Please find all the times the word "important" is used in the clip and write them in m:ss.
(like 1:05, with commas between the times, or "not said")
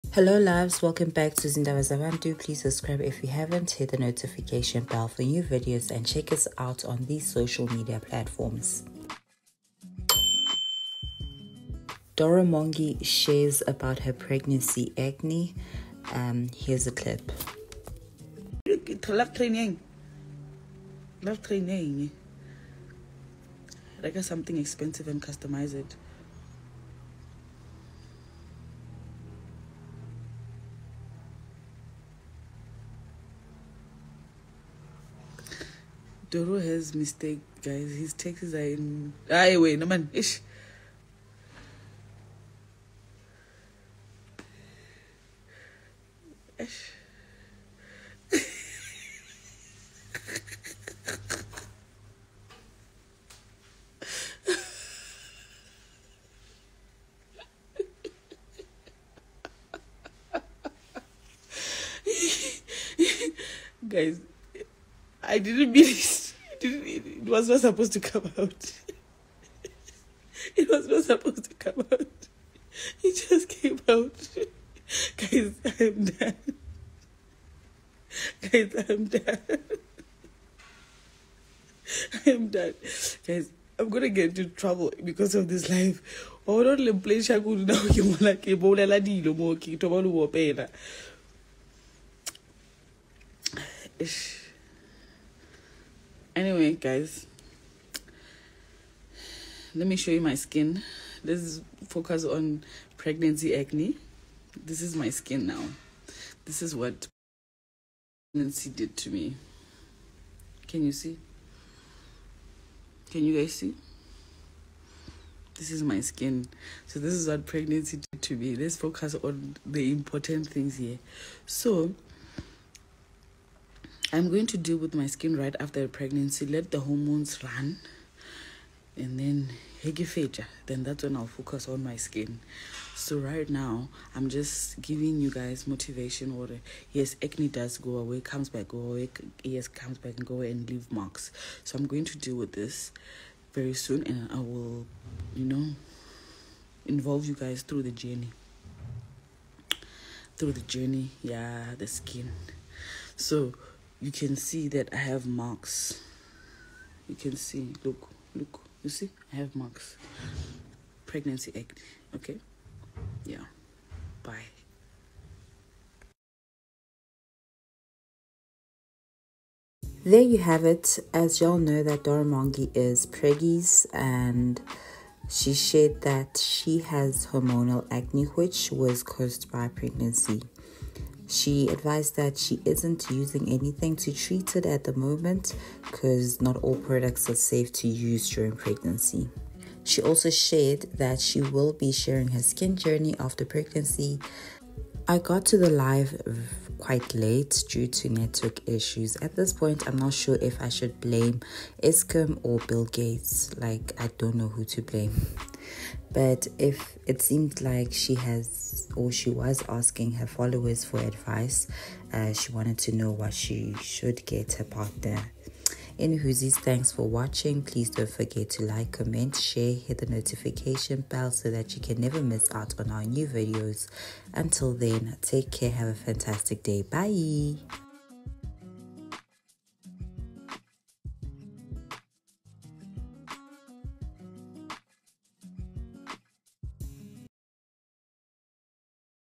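1:59.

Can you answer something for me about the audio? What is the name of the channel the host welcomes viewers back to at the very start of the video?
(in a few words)
Zindawa.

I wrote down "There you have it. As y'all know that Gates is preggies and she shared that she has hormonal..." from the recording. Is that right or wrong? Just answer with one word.
wrong.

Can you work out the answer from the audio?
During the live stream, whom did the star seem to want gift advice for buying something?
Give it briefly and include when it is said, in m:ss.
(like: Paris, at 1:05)
Her partner, at 3:34.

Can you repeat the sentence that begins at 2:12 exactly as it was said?
So right now, I'm just giving you guys motivation.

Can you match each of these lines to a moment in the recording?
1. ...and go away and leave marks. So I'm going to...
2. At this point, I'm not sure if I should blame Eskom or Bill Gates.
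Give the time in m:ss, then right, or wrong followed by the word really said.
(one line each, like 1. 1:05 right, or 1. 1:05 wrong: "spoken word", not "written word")
1. 2:20 right
2. 3:19 right.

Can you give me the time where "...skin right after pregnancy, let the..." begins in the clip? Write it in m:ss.
2:05.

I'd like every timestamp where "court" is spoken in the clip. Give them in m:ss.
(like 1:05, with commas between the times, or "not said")
not said.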